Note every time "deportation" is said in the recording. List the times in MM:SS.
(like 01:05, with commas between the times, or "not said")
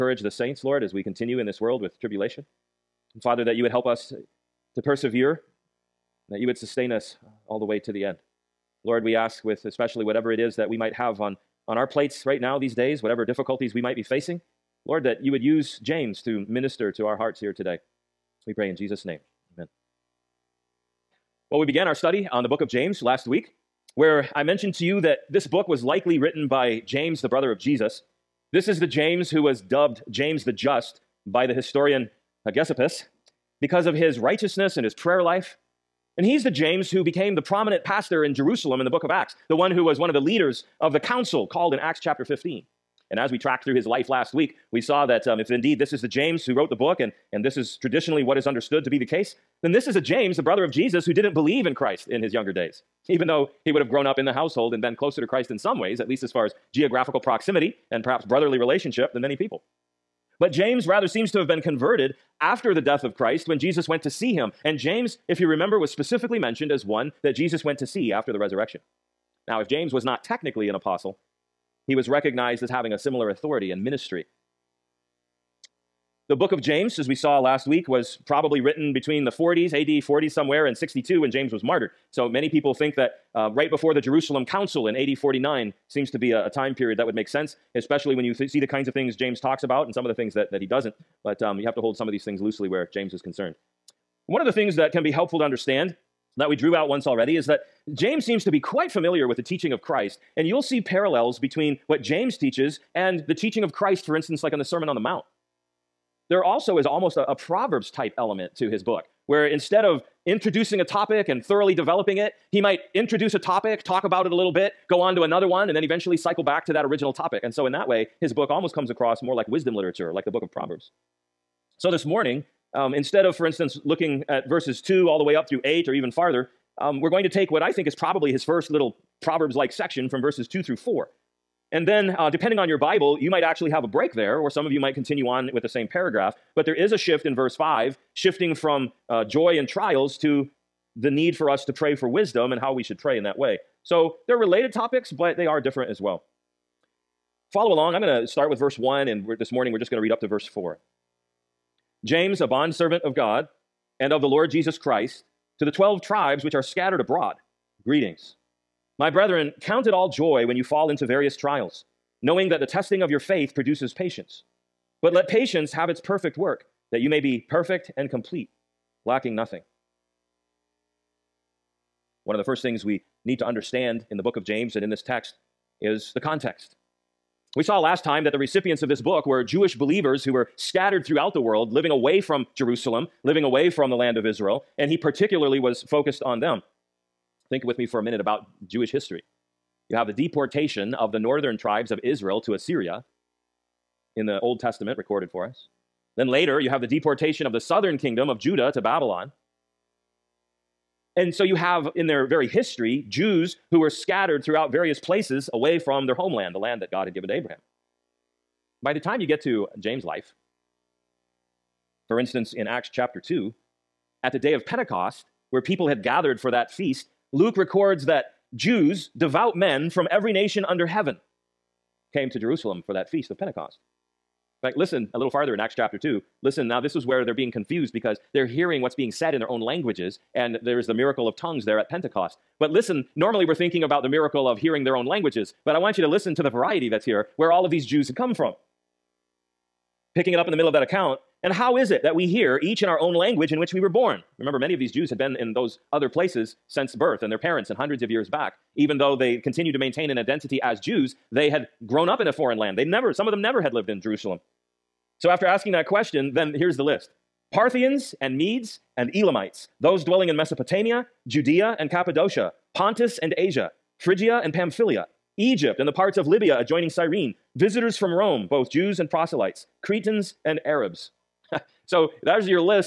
03:10, 03:16.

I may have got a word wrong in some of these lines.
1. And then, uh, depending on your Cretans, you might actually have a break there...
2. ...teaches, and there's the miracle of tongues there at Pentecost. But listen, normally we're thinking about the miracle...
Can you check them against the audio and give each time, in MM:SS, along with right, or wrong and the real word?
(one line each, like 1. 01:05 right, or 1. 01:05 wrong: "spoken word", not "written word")
1. 02:11 wrong: "Bible", not "Cretans"
2. 03:49 wrong: "languages", not "teaches".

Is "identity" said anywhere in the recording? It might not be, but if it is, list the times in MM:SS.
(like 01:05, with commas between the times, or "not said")
04:10.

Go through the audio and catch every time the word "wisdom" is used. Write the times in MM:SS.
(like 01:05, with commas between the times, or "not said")
01:59, 02:22.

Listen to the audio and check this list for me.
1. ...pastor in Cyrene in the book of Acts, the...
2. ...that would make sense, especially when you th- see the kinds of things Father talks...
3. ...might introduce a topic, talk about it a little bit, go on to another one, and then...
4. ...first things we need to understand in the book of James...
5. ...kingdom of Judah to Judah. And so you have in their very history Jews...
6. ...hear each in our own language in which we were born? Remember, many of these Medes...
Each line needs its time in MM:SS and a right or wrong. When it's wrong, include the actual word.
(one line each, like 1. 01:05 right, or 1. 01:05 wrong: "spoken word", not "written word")
1. 00:37 wrong: "Jerusalem", not "Cyrene"
2. 01:26 wrong: "James", not "Father"
3. 01:52 right
4. 02:52 right
5. 03:17 wrong: "Babylon", not "Judah"
6. 04:02 wrong: "Jews", not "Medes".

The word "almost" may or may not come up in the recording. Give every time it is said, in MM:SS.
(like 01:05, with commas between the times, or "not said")
01:46, 01:58.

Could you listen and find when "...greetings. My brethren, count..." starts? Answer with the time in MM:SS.
02:37.